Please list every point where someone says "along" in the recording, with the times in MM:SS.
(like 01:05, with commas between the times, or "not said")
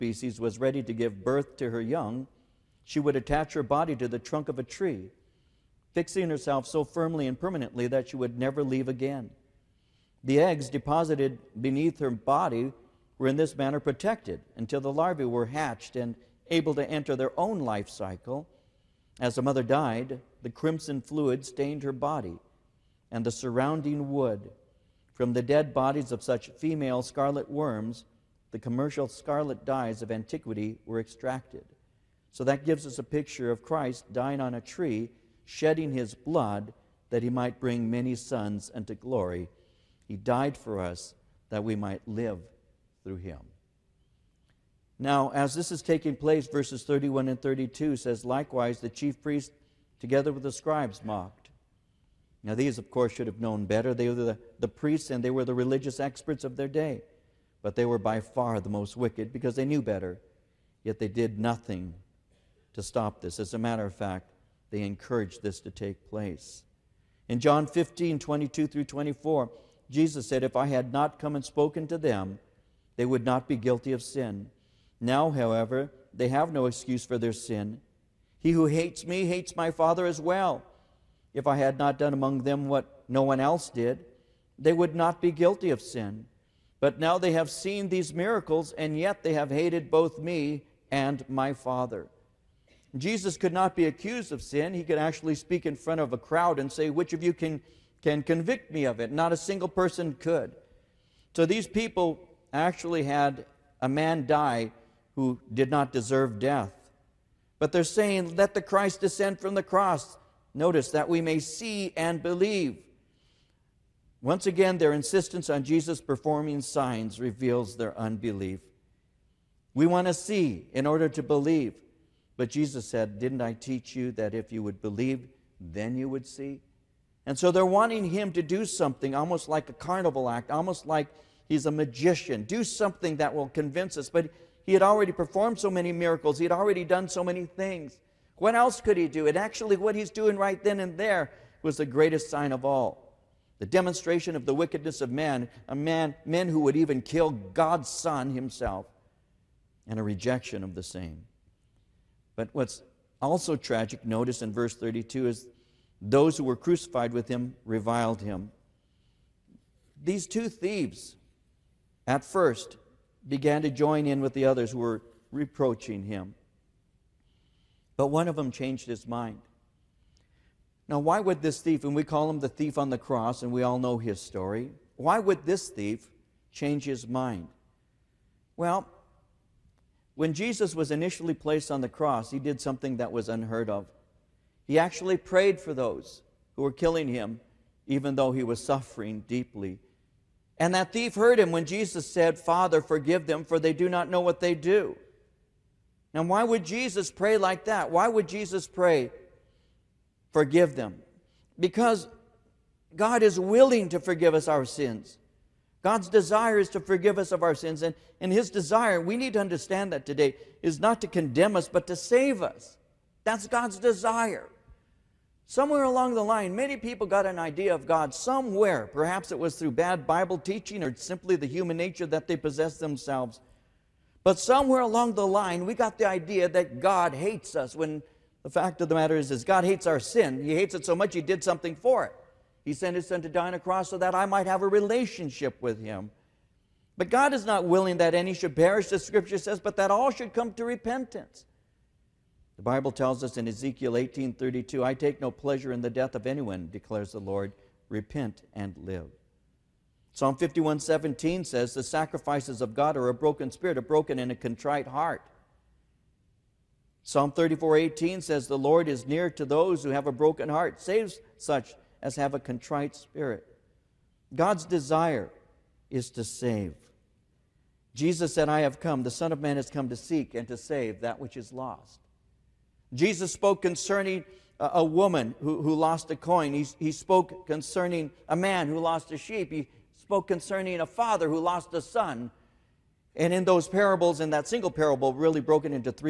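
03:35, 03:44.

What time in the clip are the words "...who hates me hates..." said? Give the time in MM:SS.
01:18.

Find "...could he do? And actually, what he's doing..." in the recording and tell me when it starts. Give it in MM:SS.
02:18.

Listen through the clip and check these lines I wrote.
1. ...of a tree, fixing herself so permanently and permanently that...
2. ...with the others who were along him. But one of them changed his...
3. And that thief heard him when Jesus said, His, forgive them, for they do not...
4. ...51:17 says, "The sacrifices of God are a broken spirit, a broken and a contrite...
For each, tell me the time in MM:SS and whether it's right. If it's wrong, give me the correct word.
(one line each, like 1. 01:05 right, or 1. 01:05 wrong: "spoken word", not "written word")
1. 00:04 wrong: "firmly", not "permanently"
2. 02:44 wrong: "reproaching", not "along"
3. 03:10 wrong: "Father", not "His"
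4. 04:10 right.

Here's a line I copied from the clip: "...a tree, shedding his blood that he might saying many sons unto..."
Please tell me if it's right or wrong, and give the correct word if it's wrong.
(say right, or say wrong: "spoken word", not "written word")
wrong: "bring", not "saying".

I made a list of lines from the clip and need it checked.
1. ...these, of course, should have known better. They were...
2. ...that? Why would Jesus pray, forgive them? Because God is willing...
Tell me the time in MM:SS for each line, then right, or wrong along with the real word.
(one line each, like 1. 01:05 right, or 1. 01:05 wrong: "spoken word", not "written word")
1. 00:52 right
2. 03:17 right.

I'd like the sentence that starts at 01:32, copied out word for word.
Jesus could not be accused of sin.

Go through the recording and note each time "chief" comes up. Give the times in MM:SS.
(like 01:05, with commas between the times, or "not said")
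00:48.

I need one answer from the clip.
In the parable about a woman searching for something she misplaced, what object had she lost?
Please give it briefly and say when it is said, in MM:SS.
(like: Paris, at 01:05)
A coin, at 04:36.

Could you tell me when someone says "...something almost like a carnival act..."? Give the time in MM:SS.
02:08.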